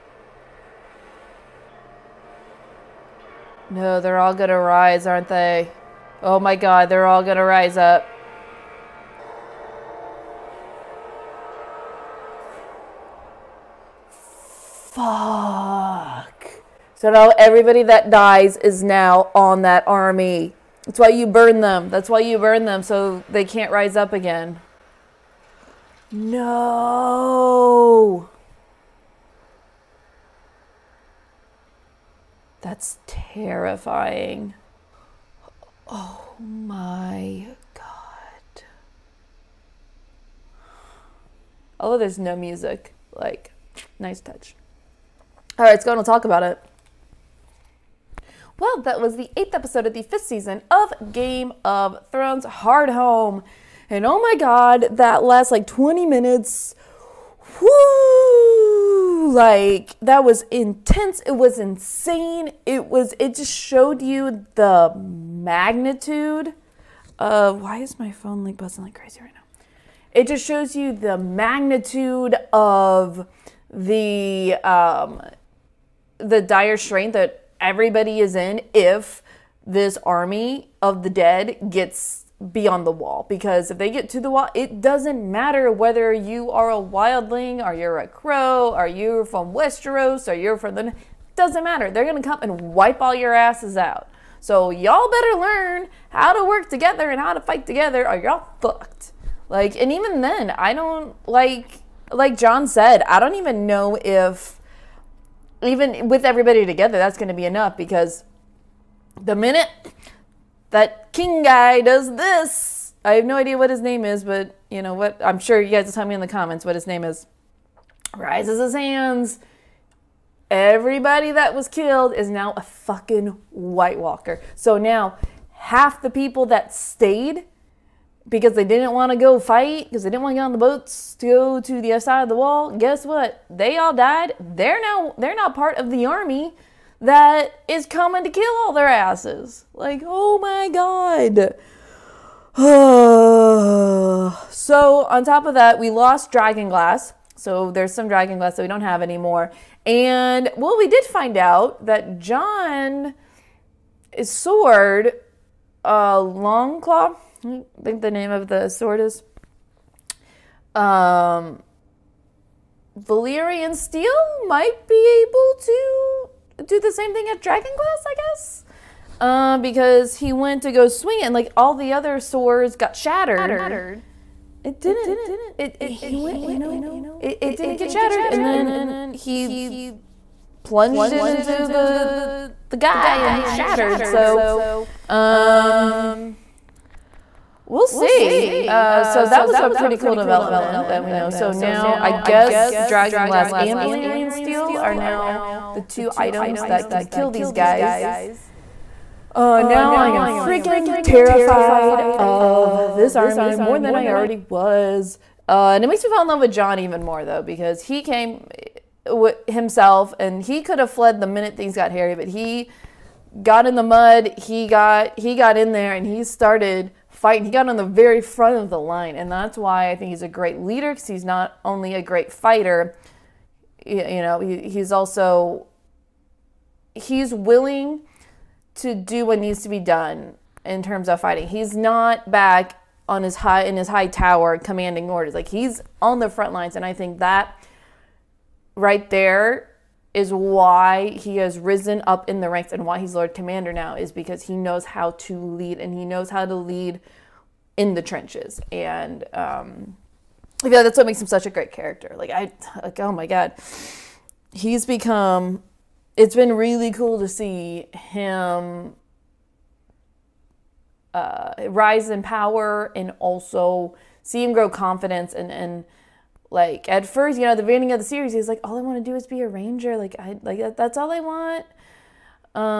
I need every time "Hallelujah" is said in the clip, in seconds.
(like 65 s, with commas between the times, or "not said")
not said.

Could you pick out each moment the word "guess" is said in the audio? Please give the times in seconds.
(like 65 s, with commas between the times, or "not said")
132 s, 168 s, 192 s.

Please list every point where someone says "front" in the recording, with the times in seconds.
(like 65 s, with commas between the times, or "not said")
218 s, 236 s.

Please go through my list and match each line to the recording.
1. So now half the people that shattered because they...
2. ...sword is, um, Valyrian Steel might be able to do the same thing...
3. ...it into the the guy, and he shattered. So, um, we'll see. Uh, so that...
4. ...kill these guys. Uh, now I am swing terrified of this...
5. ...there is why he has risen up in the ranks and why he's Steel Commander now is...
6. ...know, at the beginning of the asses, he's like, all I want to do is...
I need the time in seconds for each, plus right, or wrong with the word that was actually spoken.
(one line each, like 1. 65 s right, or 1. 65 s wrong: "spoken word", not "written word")
1. 124 s wrong: "stayed", not "shattered"
2. 158 s right
3. 181 s right
4. 197 s wrong: "freaking", not "swing"
5. 239 s wrong: "Lord", not "Steel"
6. 267 s wrong: "series", not "asses".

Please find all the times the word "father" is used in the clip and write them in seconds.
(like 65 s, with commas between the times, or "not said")
not said.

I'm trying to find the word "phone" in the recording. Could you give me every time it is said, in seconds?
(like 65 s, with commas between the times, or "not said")
68 s.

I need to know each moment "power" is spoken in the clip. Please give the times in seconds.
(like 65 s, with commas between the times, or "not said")
262 s.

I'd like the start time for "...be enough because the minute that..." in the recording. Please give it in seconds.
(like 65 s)
107 s.